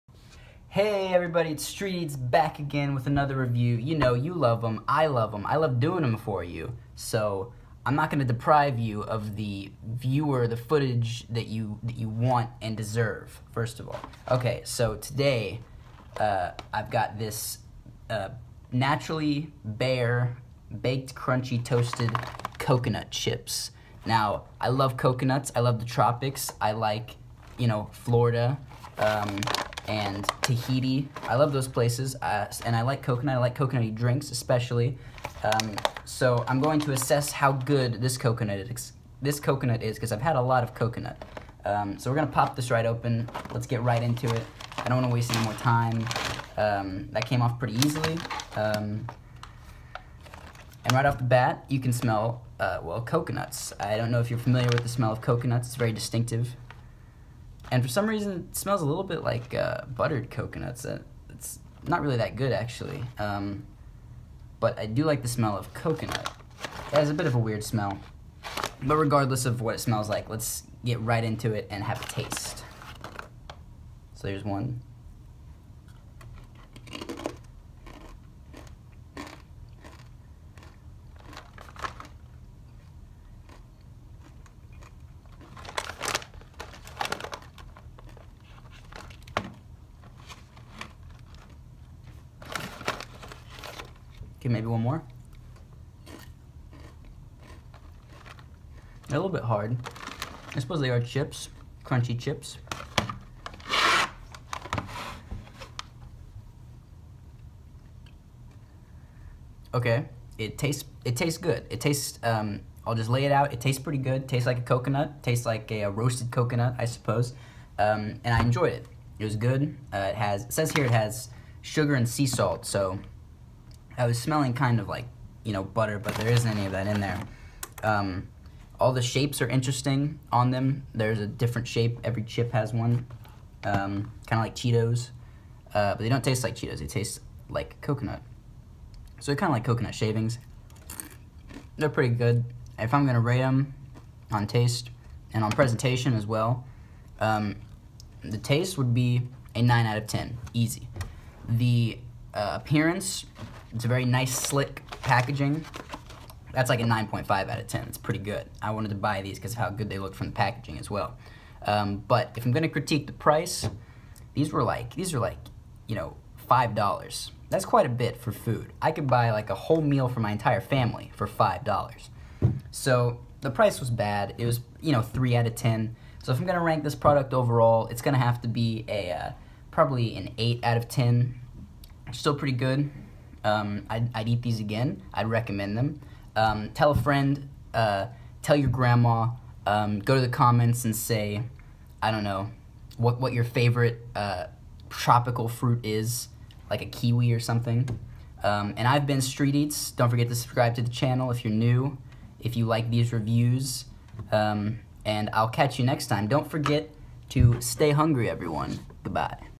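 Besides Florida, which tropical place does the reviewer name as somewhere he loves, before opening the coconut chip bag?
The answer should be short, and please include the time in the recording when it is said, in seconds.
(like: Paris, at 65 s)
Tahiti, at 30 s.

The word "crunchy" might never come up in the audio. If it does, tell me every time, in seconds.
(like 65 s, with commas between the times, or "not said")
21 s, 101 s.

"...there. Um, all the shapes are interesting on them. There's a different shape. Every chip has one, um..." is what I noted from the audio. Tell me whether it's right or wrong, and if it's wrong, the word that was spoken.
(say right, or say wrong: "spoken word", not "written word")
right.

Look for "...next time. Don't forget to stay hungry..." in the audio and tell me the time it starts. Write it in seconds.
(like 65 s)
205 s.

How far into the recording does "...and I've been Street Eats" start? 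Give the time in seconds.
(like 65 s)
198 s.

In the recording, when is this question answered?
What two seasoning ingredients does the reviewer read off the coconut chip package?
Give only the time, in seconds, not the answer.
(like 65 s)
121 s.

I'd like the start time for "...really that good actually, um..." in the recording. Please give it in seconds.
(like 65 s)
62 s.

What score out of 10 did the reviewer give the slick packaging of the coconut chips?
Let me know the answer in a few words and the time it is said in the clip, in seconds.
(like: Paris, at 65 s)
9.5, at 156 s.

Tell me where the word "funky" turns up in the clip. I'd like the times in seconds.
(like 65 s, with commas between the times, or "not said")
not said.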